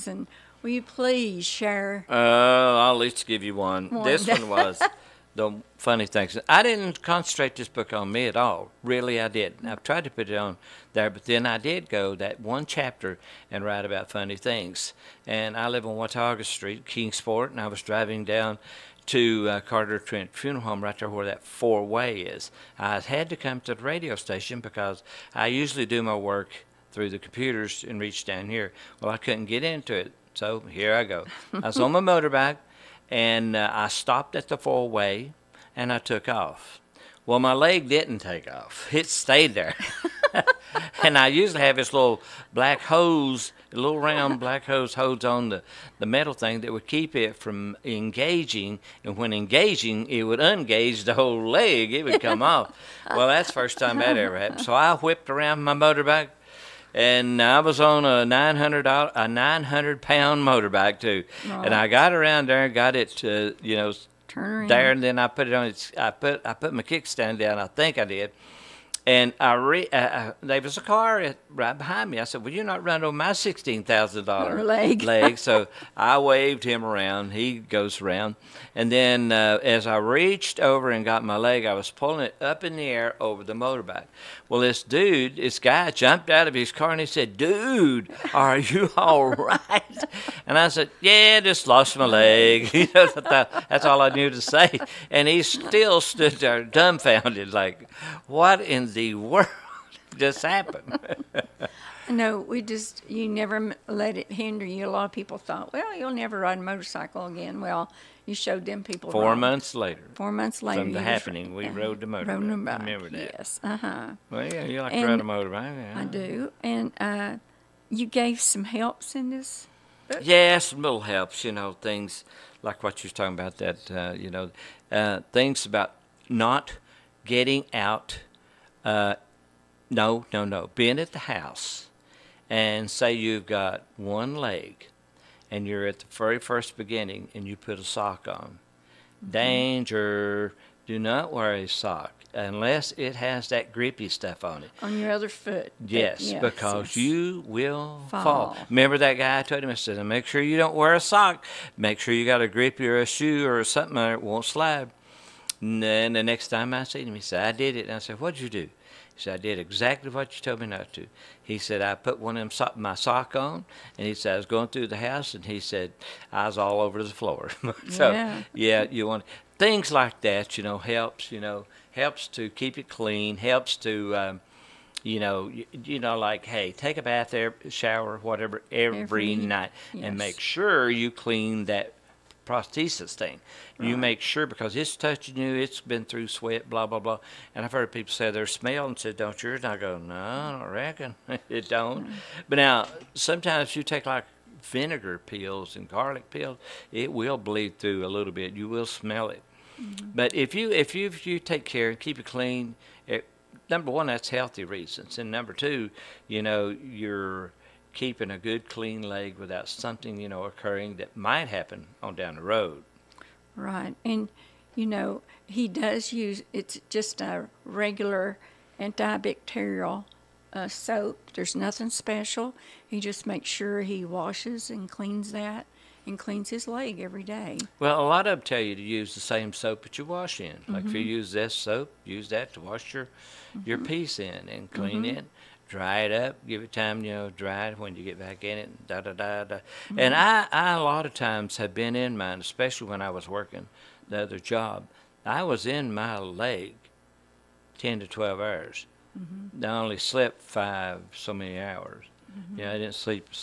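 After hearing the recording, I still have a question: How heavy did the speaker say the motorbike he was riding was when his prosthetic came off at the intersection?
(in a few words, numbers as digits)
900 pounds.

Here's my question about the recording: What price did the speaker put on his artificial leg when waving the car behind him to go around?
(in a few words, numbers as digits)
$16,000.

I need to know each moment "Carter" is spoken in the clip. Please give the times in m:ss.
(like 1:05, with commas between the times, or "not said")
0:19.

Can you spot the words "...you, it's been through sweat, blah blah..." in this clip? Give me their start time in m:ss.
3:05.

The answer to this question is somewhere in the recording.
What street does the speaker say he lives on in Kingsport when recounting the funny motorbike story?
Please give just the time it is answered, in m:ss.
0:15.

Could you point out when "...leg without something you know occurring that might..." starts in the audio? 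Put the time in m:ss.
3:29.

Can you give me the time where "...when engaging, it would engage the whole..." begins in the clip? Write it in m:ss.
0:49.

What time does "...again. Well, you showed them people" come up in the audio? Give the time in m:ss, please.
1:47.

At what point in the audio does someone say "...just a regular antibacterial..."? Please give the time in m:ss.
3:36.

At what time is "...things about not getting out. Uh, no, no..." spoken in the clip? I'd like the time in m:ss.
2:05.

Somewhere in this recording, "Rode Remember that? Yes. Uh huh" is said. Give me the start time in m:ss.
1:52.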